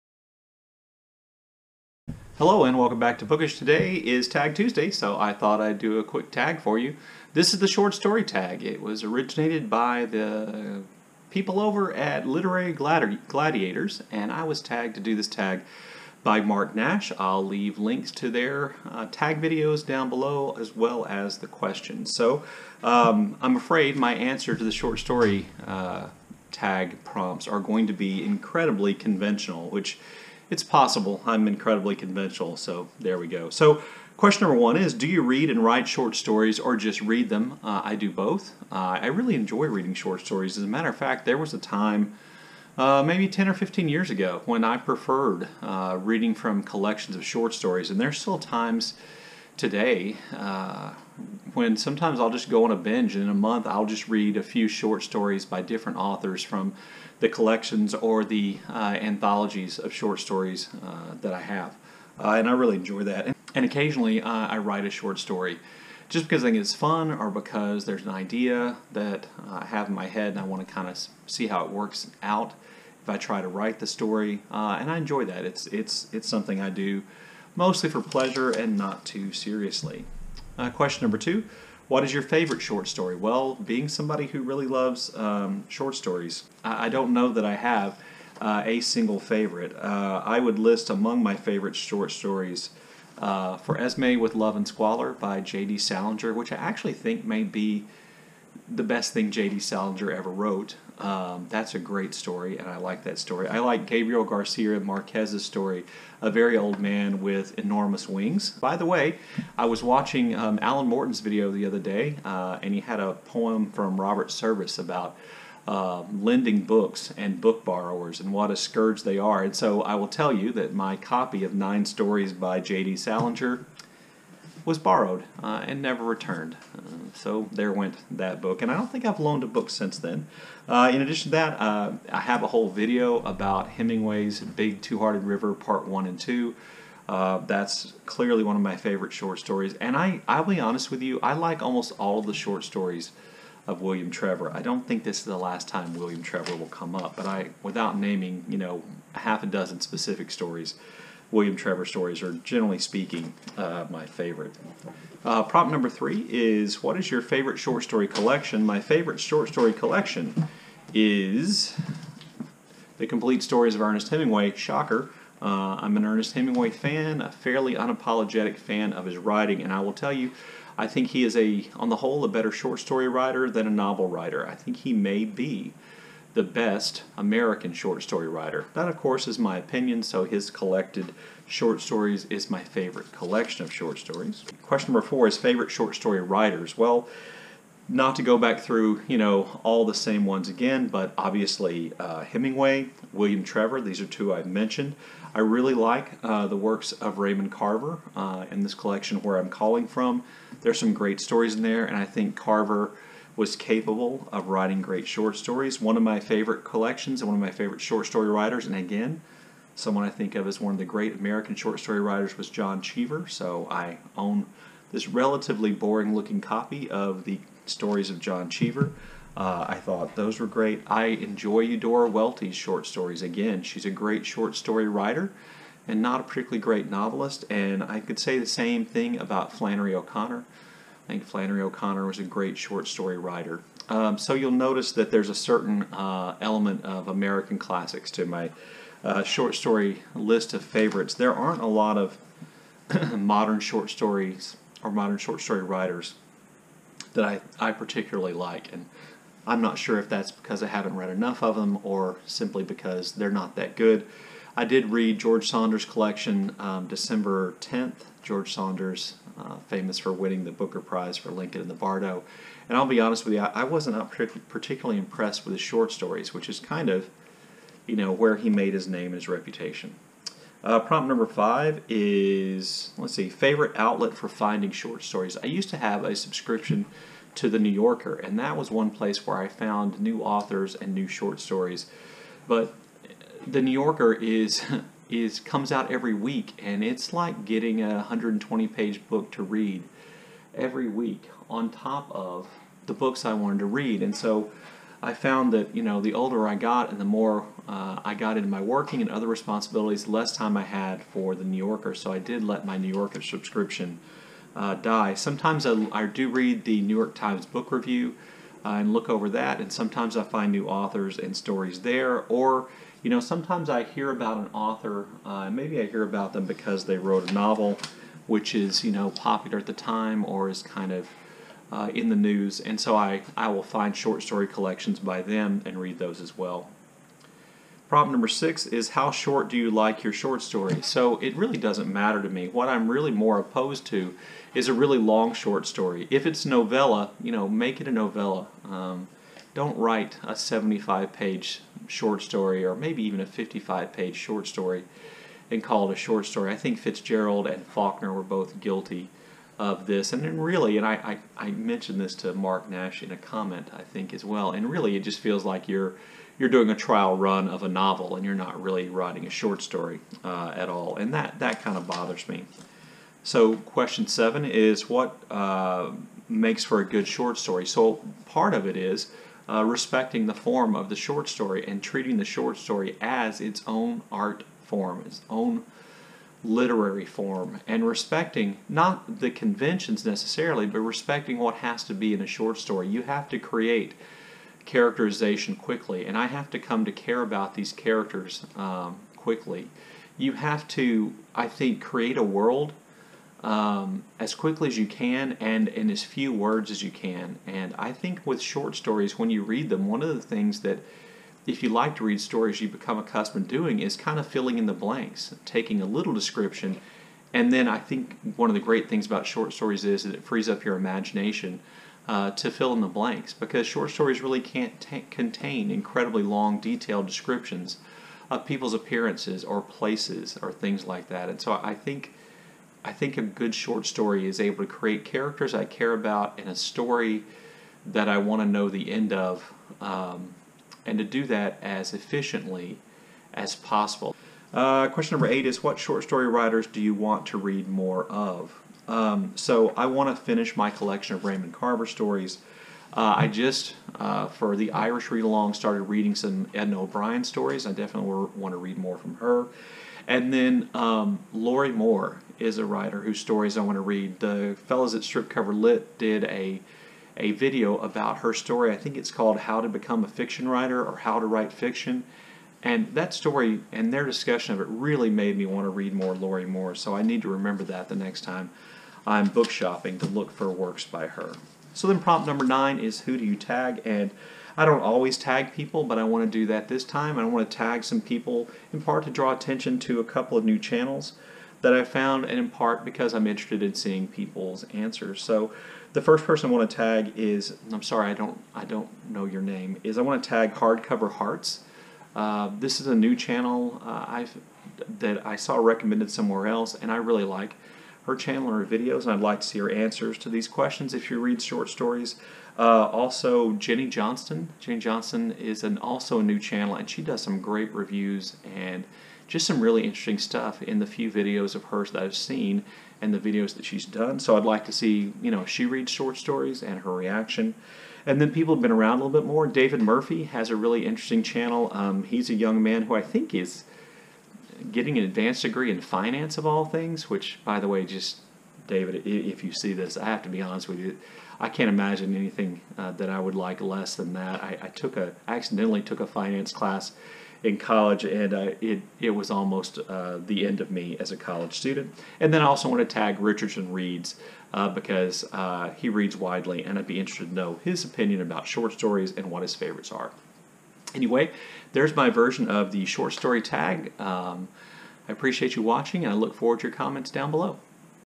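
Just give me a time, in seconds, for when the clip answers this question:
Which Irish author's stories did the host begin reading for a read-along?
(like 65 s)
446 s.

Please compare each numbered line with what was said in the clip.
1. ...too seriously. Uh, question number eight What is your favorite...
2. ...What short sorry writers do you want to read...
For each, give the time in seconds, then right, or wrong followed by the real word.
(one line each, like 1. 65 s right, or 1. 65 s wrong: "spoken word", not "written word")
1. 79 s wrong: "two", not "eight"
2. 435 s wrong: "story", not "sorry".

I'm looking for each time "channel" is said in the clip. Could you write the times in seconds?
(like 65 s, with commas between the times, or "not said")
480 s, 493 s, 498 s, 506 s, 521 s.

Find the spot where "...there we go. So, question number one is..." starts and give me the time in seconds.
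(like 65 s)
32 s.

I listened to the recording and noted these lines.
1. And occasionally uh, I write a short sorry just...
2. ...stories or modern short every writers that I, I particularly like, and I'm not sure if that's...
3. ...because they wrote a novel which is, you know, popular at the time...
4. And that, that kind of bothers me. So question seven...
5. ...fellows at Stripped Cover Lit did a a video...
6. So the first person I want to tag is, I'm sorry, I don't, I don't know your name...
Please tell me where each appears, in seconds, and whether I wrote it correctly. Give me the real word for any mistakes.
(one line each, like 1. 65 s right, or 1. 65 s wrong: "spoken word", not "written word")
1. 63 s wrong: "story", not "sorry"
2. 243 s wrong: "story", not "every"
3. 316 s right
4. 360 s right
5. 454 s right
6. 485 s right.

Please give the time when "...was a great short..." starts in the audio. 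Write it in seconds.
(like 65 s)
232 s.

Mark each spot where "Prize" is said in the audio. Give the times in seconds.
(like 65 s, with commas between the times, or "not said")
260 s.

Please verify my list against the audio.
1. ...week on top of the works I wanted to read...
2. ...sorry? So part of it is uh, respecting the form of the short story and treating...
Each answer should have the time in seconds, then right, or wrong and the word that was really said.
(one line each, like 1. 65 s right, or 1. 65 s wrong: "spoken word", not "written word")
1. 290 s wrong: "books", not "works"
2. 367 s wrong: "story", not "sorry".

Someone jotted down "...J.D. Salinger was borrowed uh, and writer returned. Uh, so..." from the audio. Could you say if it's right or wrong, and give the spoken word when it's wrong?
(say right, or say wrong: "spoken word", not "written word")
wrong: "never", not "writer".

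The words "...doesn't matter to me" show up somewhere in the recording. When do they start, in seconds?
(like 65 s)
331 s.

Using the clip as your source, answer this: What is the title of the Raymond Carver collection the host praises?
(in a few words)
Where I'm Calling From.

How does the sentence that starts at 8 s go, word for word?
It was originated by the people over at Literary Gladi Gladiators, and I was tagged to do this tag by Marc Nash.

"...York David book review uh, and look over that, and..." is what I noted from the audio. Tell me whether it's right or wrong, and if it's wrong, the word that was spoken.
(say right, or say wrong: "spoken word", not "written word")
wrong: "Times", not "David".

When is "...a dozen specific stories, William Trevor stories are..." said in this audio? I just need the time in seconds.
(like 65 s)
149 s.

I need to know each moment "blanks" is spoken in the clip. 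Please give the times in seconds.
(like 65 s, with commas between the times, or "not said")
404 s, 412 s.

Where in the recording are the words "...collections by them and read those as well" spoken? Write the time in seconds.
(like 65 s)
324 s.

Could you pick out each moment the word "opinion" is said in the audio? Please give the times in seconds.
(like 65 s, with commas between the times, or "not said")
179 s, 547 s.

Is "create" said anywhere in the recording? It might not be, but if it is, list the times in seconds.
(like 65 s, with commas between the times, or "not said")
383 s, 391 s, 424 s.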